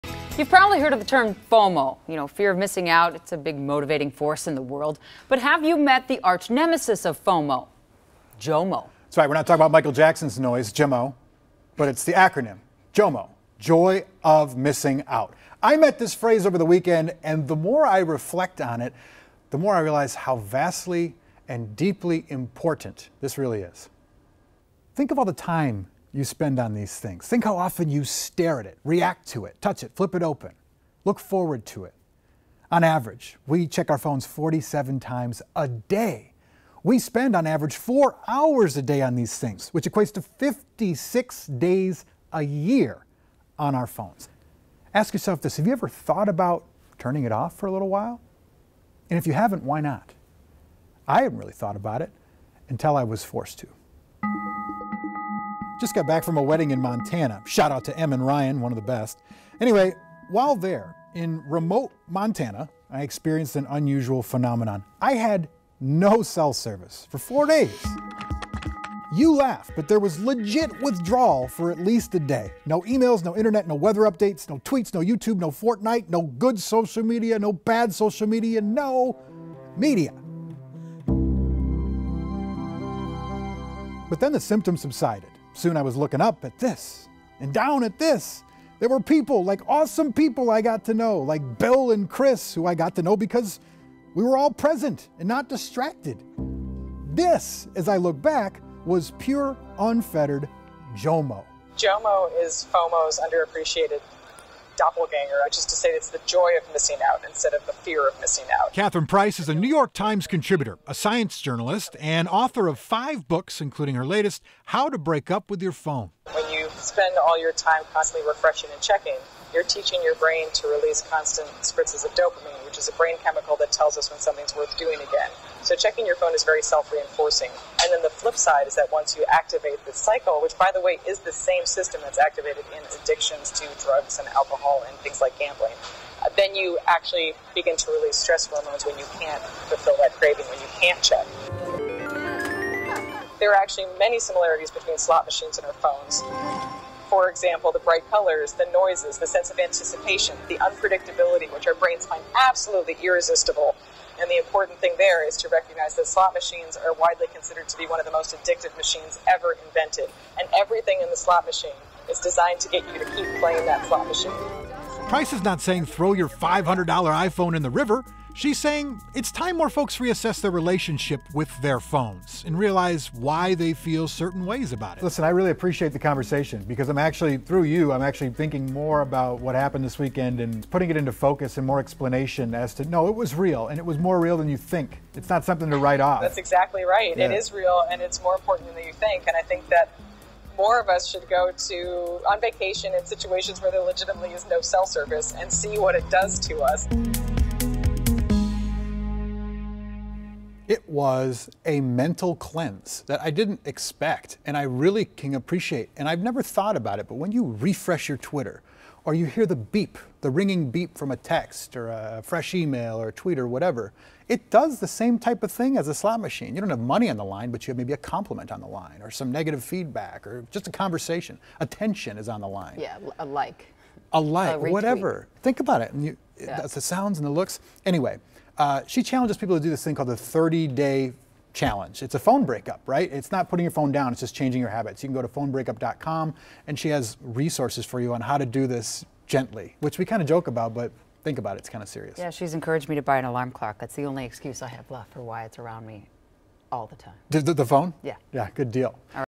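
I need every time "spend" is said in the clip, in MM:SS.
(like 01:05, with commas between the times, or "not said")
00:26, 00:36, 01:56.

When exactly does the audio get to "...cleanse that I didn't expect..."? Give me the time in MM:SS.
03:22.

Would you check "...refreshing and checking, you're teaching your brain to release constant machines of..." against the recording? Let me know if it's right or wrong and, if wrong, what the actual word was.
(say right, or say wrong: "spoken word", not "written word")
wrong: "spritzes", not "machines".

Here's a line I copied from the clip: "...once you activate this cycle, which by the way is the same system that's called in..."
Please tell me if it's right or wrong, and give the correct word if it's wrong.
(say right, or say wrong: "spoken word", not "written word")
wrong: "activated", not "called".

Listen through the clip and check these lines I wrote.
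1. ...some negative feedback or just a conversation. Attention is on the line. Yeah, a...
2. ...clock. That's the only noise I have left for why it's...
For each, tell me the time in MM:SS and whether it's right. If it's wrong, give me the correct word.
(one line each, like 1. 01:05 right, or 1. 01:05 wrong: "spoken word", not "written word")
1. 03:39 right
2. 04:03 wrong: "excuse", not "noise".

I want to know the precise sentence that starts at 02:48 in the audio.
She's saying it's time more folks reassess their relationship with their phones and realize why they feel certain ways about it.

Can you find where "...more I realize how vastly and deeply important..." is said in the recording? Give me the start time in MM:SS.
00:19.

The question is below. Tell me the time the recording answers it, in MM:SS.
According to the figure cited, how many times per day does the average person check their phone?
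00:34.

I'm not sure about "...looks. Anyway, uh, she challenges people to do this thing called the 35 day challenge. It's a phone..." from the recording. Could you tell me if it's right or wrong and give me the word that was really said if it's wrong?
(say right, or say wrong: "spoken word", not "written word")
wrong: "30", not "35".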